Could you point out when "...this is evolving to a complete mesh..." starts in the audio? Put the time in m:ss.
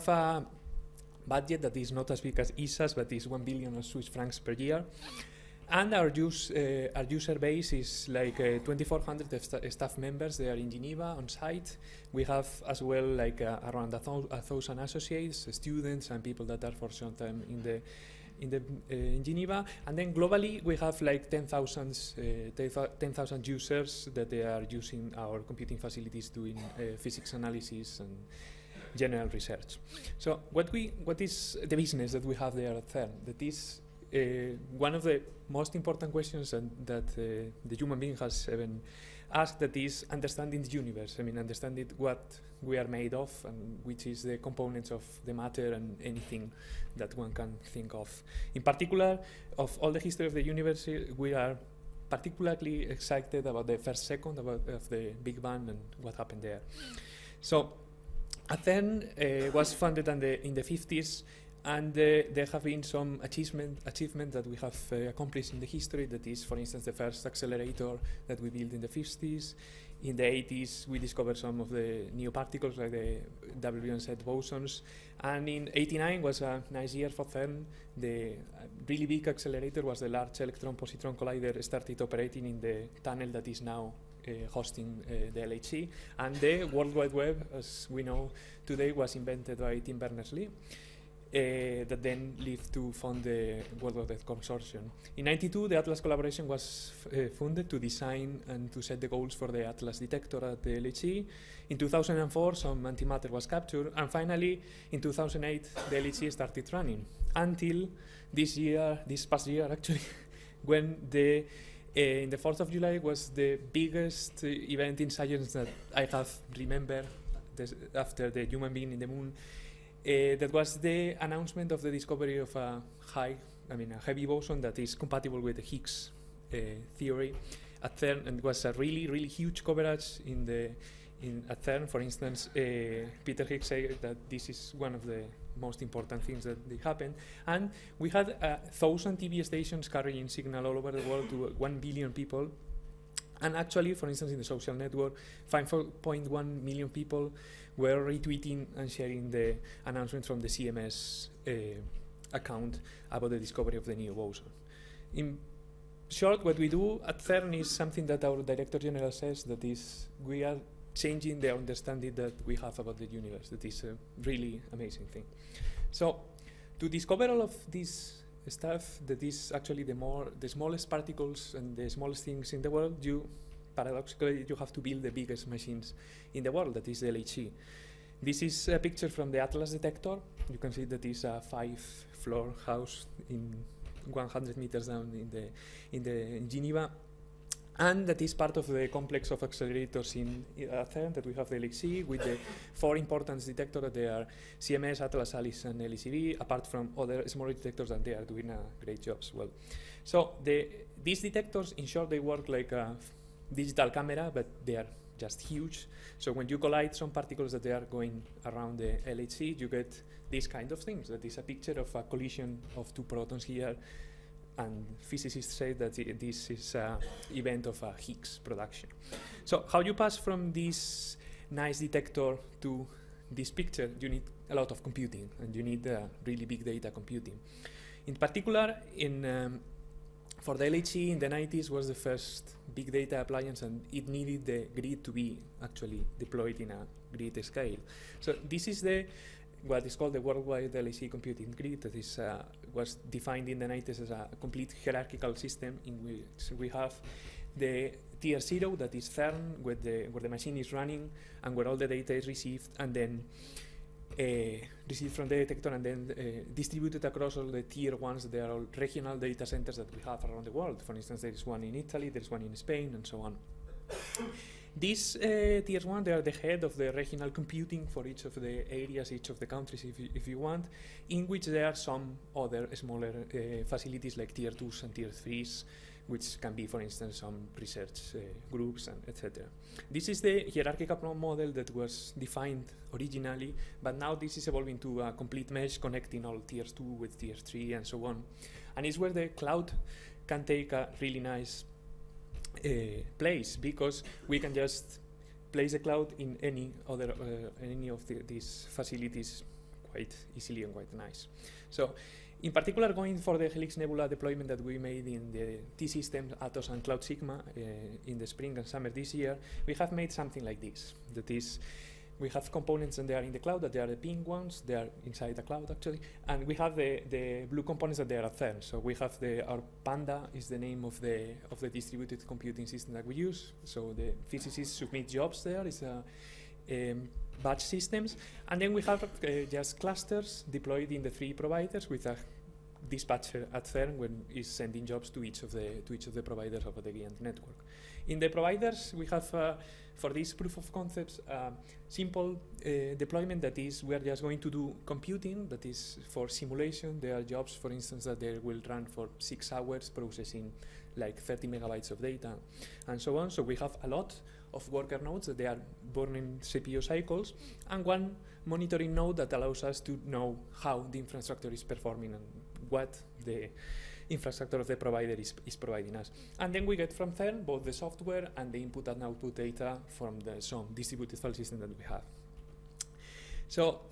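4:44.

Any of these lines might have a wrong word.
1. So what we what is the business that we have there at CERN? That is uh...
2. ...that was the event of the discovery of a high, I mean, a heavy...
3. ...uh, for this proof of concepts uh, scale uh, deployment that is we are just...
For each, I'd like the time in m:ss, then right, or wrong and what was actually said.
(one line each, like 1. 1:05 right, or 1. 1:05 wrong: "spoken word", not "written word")
1. 0:30 right
2. 2:00 wrong: "announcement", not "event"
3. 5:39 wrong: "simple", not "scale".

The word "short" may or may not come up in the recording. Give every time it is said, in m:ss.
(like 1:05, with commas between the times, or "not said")
2:36, 3:21.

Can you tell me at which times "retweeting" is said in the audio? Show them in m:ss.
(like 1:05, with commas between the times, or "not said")
2:28.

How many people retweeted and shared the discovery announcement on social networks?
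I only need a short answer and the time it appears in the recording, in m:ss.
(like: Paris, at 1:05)
5.1 million, at 2:25.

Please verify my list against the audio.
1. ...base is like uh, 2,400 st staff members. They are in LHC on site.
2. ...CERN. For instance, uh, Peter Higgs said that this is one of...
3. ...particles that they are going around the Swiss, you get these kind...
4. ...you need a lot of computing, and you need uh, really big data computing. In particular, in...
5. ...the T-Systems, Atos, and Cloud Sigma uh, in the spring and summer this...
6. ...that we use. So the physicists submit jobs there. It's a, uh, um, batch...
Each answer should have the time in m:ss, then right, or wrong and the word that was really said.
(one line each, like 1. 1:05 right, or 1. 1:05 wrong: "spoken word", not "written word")
1. 0:07 wrong: "Geneva", not "LHC"
2. 2:11 right
3. 3:27 wrong: "LHC", not "Swiss"
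4. 3:44 right
5. 5:05 right
6. 5:22 right.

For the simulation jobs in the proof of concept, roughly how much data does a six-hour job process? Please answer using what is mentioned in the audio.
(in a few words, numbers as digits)
30 megabytes.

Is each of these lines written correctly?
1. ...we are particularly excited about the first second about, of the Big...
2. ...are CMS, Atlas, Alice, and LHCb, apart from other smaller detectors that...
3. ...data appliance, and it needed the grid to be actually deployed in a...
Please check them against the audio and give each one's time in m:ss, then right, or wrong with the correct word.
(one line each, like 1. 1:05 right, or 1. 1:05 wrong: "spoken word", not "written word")
1. 0:51 right
2. 3:14 right
3. 3:52 right.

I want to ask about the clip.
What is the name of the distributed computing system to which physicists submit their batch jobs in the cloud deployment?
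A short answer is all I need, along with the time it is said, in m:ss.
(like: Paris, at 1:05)
Panda, at 5:19.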